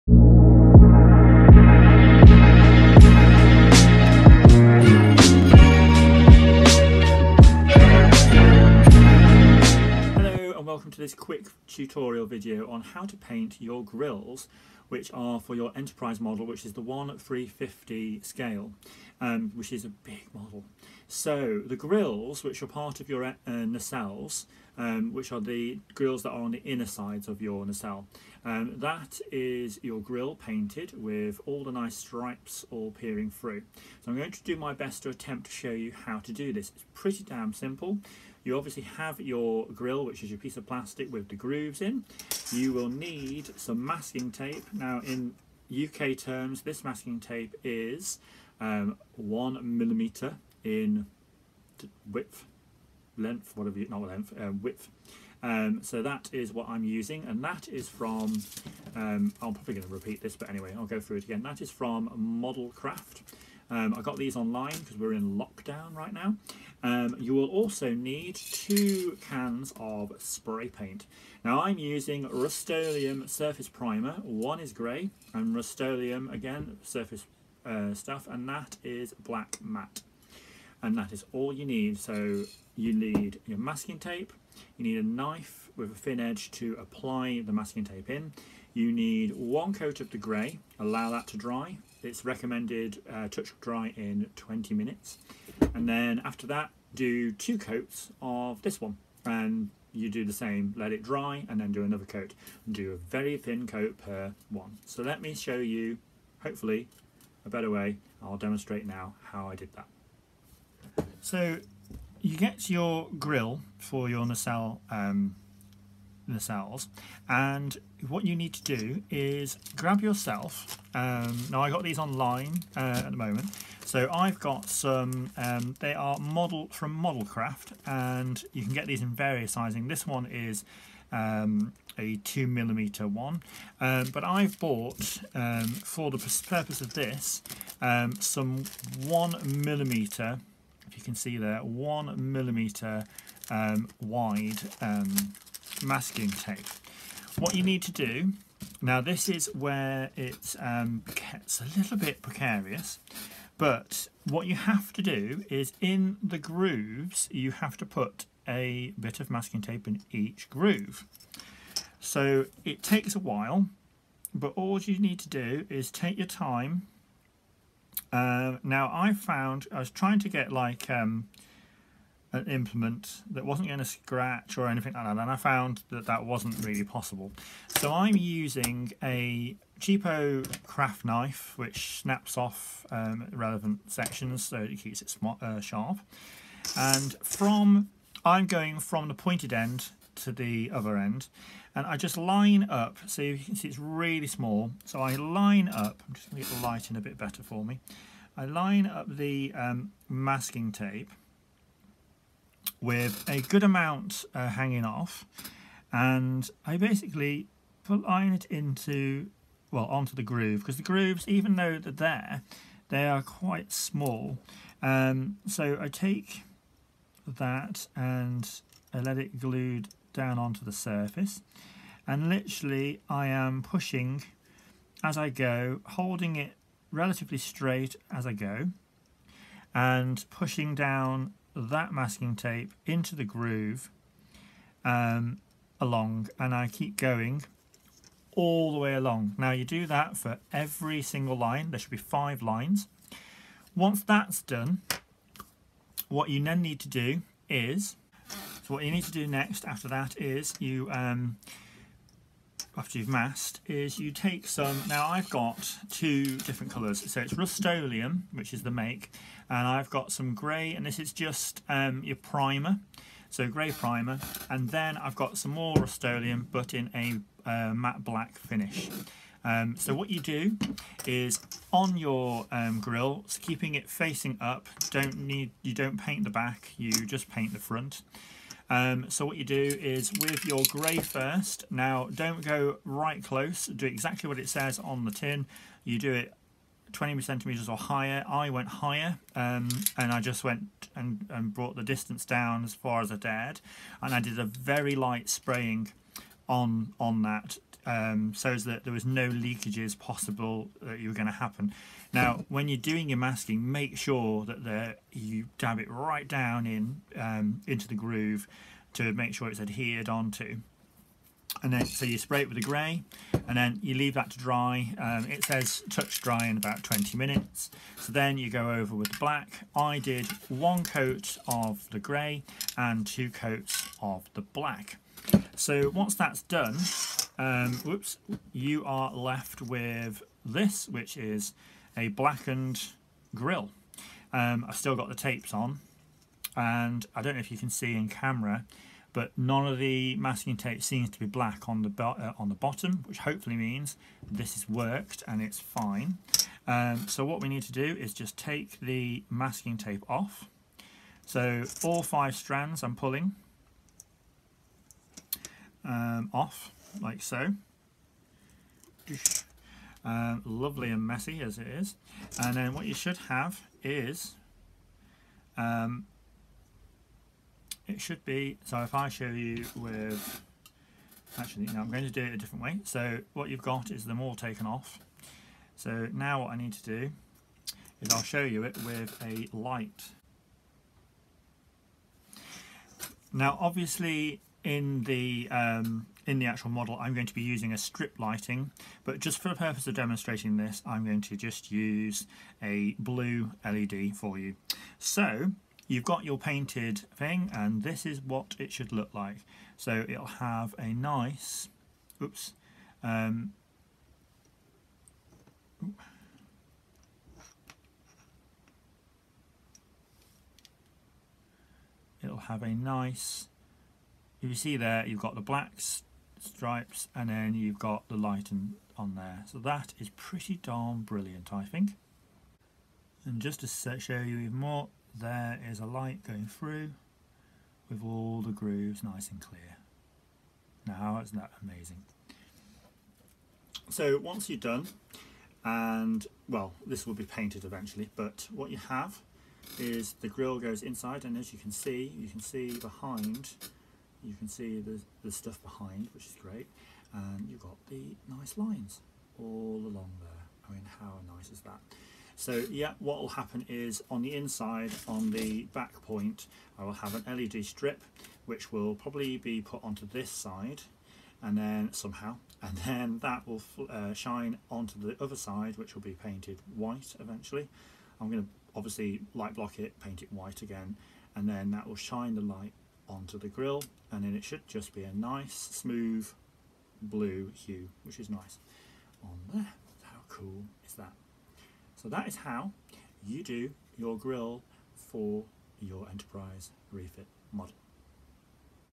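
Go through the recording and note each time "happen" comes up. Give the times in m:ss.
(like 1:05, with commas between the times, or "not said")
5:01, 7:33.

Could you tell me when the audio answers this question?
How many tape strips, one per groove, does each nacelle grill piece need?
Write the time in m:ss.
4:01.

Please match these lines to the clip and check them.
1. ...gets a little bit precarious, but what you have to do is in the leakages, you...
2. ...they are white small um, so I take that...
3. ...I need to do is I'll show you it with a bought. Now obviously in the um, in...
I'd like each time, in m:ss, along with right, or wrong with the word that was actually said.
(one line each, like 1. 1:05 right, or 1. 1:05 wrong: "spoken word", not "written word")
1. 2:31 wrong: "grooves", not "leakages"
2. 3:32 wrong: "quite", not "white"
3. 6:16 wrong: "light", not "bought".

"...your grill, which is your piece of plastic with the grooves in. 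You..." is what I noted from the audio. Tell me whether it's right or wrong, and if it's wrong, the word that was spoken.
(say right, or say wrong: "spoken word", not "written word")
right.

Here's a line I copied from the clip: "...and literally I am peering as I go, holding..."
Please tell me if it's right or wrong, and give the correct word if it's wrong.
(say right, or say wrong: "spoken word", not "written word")
wrong: "pushing", not "peering".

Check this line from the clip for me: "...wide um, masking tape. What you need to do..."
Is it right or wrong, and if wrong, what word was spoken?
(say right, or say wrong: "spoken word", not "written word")
right.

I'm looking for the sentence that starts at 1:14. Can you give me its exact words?
One is grey and Rust-Oleum, again, surface uh, stuff, and that is black matte and that is all you need.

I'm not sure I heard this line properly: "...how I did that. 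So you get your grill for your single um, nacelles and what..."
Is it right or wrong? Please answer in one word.
wrong.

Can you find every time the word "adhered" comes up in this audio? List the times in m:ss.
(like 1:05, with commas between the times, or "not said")
5:09.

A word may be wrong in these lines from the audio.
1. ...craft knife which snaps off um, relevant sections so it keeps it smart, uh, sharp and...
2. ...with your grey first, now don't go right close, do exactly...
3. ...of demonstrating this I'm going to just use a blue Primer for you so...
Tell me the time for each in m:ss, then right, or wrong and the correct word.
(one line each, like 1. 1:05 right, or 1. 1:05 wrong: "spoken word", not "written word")
1. 3:00 right
2. 4:40 right
3. 6:29 wrong: "LED", not "Primer".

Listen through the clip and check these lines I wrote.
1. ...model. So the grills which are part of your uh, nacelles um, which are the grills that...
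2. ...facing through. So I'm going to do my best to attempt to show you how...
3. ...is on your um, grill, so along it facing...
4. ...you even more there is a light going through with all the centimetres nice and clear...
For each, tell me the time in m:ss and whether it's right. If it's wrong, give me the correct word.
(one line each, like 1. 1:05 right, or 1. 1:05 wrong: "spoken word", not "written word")
1. 0:20 right
2. 0:32 wrong: "peering", not "facing"
3. 4:31 wrong: "keeping", not "along"
4. 7:04 wrong: "grooves", not "centimetres".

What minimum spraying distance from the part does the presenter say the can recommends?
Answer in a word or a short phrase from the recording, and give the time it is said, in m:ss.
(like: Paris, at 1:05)
20 centimetres, at 4:46.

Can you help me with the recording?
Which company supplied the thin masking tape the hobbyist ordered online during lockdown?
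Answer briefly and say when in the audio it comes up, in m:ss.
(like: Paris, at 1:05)
Model Craft, at 1:02.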